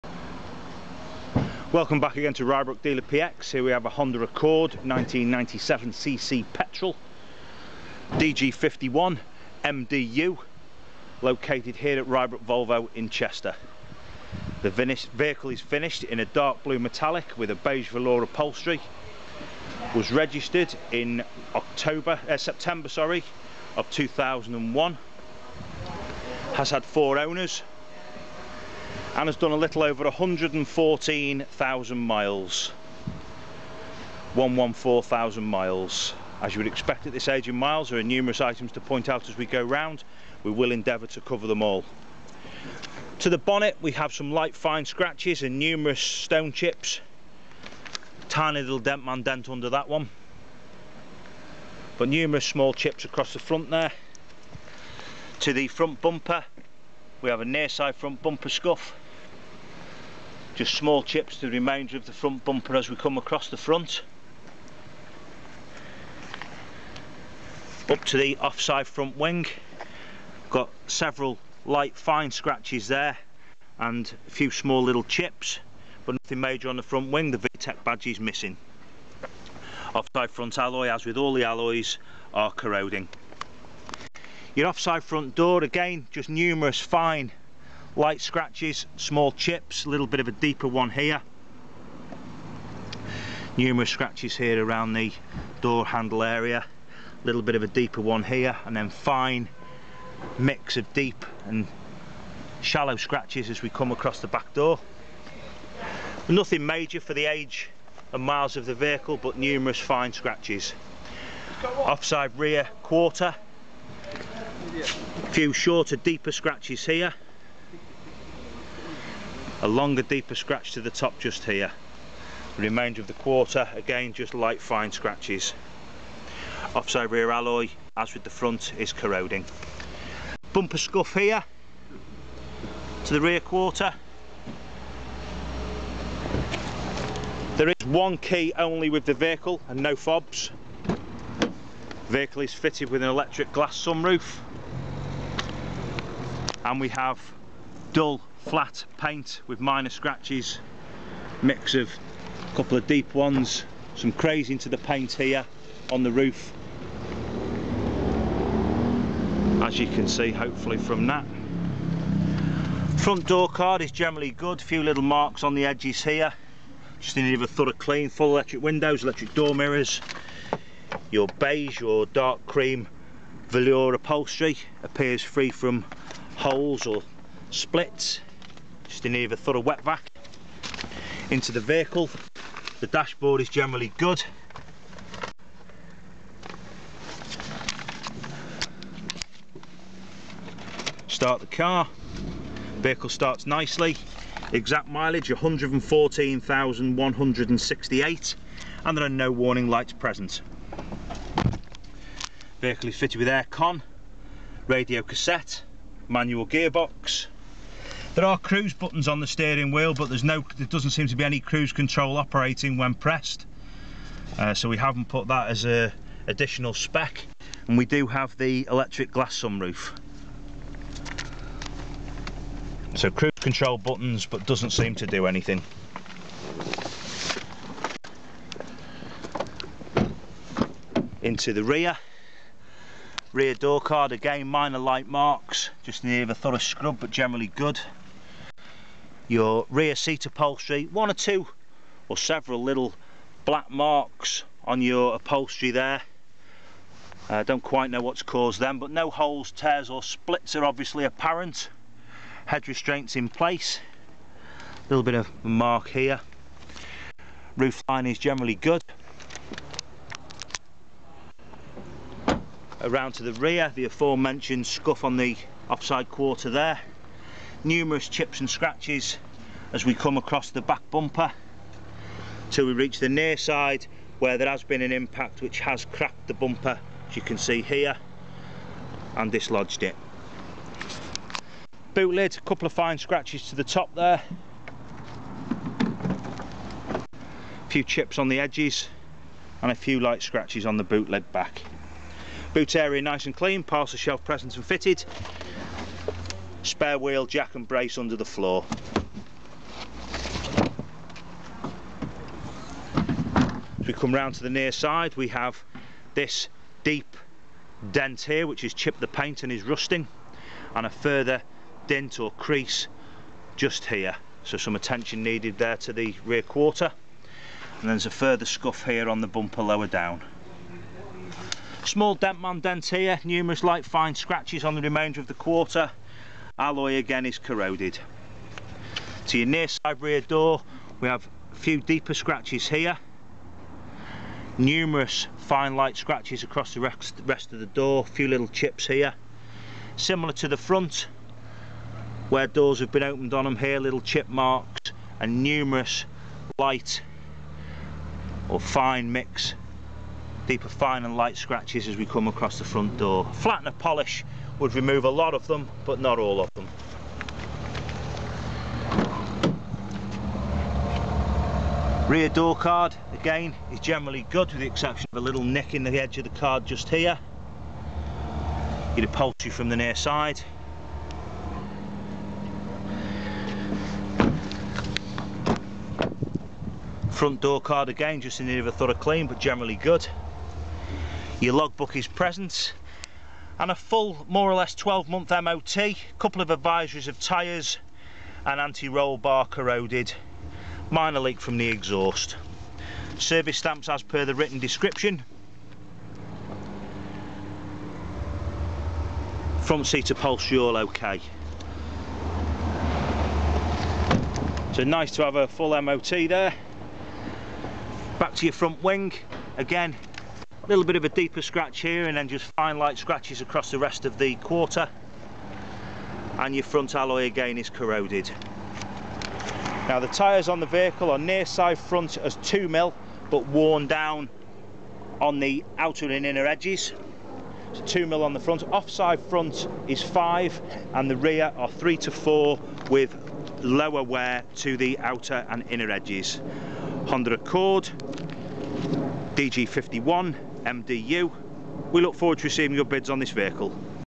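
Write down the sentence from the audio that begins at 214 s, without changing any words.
Uh, so we haven't put that as a additional spec.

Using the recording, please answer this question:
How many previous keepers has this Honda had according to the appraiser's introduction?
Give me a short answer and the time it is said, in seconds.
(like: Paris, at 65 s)
4, at 26 s.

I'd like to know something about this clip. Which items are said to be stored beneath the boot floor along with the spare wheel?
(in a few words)
jack and brace.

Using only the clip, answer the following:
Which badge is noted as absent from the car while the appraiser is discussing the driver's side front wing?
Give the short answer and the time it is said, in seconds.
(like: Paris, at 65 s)
VTEC, at 77 s.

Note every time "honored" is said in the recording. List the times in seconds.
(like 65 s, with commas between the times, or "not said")
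not said.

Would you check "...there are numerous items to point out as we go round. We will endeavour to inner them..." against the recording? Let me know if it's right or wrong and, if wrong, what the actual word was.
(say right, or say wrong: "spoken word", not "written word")
wrong: "cover", not "inner".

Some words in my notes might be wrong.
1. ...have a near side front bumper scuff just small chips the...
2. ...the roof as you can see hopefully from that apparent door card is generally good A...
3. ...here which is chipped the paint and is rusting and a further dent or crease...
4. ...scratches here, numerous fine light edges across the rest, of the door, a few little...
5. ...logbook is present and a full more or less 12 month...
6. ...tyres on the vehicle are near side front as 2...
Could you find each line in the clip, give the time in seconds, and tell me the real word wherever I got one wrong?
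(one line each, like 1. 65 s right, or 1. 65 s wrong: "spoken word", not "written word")
1. 57 s right
2. 156 s wrong: "front", not "apparent"
3. 308 s right
4. 332 s wrong: "scratches", not "edges"
5. 381 s right
6. 420 s right.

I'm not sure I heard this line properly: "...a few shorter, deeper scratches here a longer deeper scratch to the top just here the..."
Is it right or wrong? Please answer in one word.
right.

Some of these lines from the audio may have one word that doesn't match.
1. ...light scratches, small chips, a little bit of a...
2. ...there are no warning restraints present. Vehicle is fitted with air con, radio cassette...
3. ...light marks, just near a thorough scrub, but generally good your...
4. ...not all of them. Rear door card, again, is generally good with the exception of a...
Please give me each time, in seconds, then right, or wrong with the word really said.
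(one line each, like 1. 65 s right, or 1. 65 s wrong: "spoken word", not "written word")
1. 87 s right
2. 198 s wrong: "lights", not "restraints"
3. 234 s right
4. 355 s right.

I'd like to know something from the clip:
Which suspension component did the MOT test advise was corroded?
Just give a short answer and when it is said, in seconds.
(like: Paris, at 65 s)
Anti-roll bar, at 388 s.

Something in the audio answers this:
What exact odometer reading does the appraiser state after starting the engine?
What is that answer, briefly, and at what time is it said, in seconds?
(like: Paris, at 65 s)
114,168, at 195 s.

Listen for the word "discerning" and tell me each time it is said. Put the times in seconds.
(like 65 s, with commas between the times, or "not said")
not said.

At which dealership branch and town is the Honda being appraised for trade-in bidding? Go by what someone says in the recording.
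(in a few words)
Rybrook Volvo in Chester.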